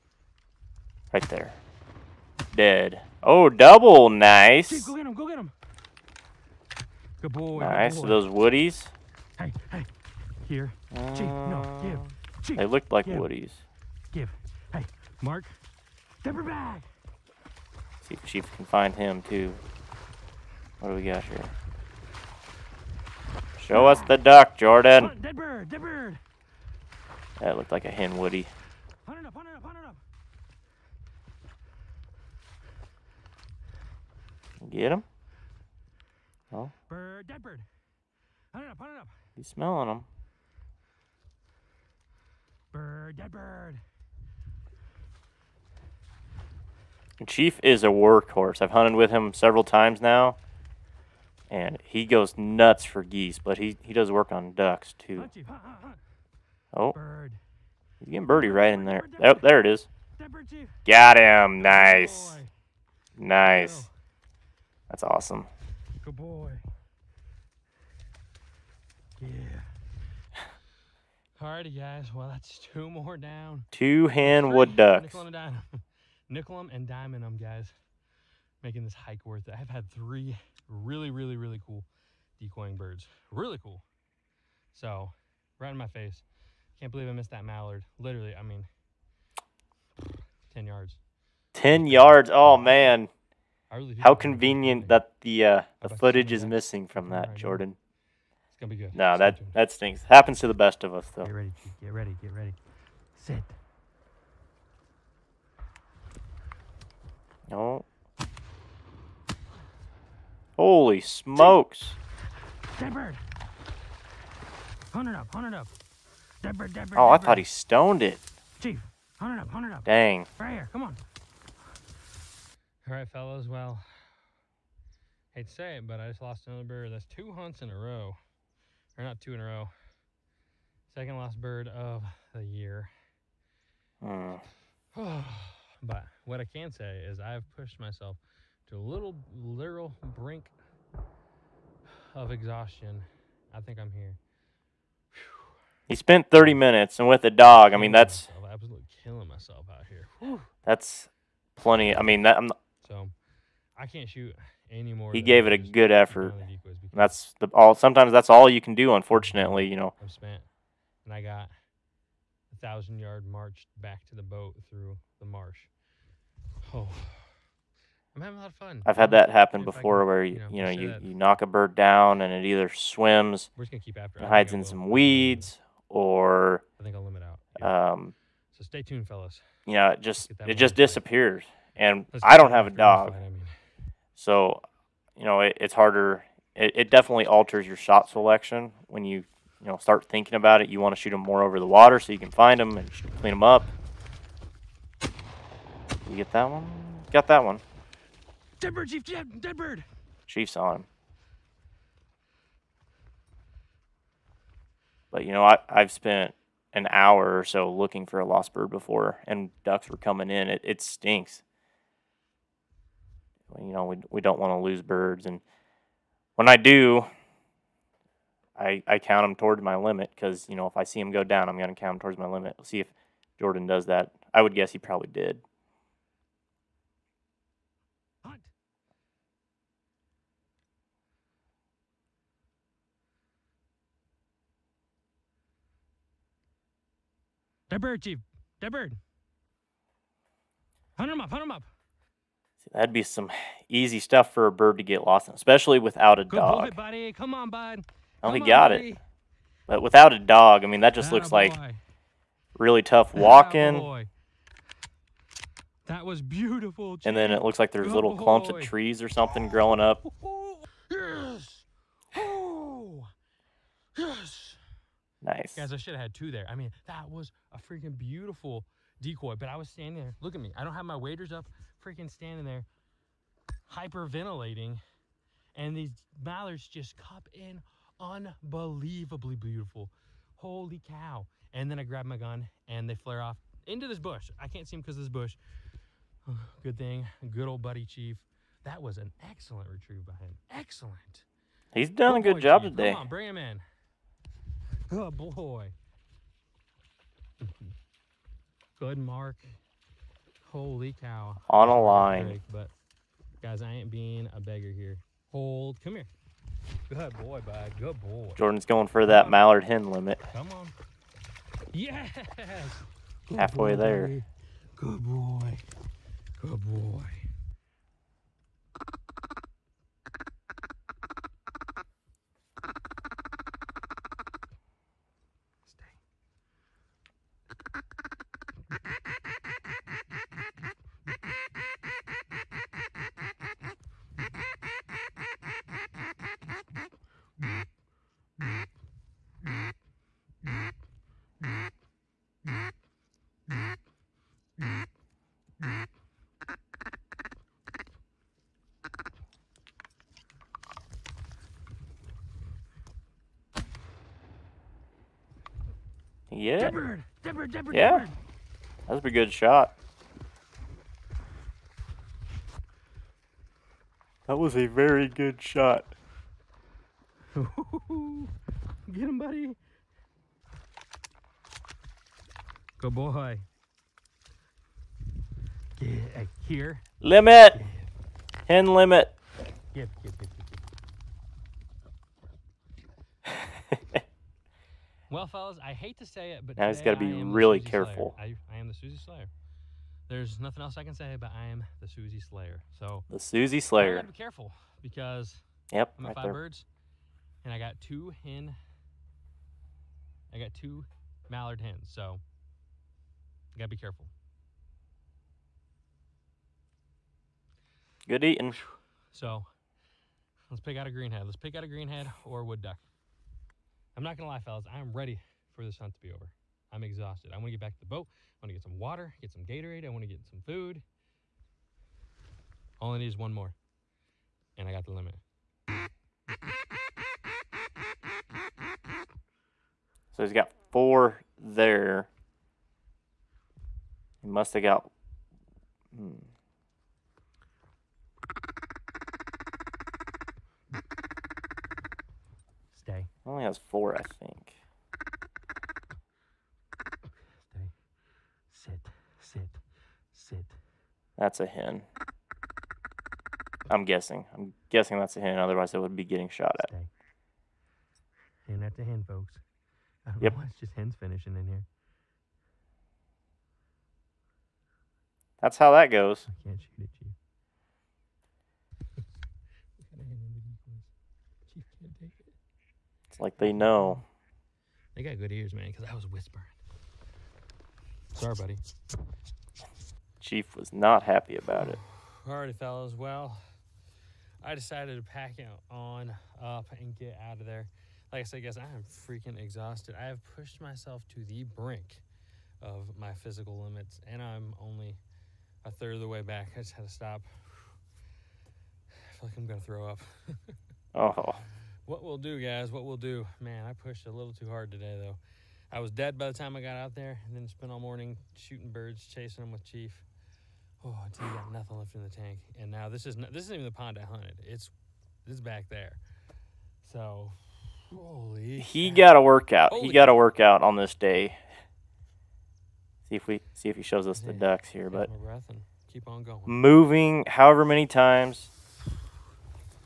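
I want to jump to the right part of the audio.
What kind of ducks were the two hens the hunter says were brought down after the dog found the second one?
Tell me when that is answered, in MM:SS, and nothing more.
01:13.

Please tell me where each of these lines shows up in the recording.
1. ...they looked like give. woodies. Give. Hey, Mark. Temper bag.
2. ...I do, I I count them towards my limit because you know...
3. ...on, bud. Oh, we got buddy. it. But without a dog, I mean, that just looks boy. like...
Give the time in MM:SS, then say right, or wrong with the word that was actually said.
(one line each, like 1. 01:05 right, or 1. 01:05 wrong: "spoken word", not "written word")
1. 00:12 right
2. 03:36 right
3. 04:07 right.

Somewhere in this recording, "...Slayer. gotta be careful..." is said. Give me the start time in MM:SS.
06:33.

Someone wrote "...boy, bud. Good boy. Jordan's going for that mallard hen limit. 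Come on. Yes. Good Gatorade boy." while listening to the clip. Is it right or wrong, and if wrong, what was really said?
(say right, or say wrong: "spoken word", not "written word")
wrong: "Halfway", not "Gatorade".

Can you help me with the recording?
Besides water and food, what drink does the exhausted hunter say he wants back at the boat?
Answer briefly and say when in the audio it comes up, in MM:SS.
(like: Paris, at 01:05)
Gatorade, at 06:59.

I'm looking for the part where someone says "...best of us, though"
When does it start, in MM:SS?
01:40.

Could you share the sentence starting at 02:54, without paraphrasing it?
and hides in some weeds, or I think I'll limit out.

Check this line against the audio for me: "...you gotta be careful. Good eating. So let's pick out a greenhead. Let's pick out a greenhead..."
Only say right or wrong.
right.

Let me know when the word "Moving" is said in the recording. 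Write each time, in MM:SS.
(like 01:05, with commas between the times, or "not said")
08:46.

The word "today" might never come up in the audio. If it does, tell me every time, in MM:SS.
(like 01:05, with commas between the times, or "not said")
04:52, 08:24.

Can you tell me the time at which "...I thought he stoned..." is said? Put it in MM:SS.
01:57.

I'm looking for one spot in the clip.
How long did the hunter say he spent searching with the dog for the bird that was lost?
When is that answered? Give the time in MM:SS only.
02:26.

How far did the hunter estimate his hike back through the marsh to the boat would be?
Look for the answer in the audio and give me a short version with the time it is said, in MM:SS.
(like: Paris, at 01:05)
1000 yards, at 02:42.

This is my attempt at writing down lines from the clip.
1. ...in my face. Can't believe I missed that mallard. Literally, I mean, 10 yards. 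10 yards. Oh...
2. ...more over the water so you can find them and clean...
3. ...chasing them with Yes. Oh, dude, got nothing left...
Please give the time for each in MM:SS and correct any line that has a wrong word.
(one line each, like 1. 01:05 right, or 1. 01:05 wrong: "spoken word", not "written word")
1. 01:25 right
2. 03:11 right
3. 08:29 wrong: "Chief", not "Yes".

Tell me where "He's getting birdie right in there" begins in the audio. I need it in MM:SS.
00:57.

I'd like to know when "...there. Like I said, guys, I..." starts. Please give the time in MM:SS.
08:07.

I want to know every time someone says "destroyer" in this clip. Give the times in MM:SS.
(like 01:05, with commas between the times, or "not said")
not said.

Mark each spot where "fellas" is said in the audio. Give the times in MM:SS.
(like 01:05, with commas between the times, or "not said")
02:03, 02:59, 06:25, 06:54, 08:02.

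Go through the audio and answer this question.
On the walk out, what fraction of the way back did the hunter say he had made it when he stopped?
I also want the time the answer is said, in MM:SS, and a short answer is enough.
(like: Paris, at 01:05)
a third, at 08:15.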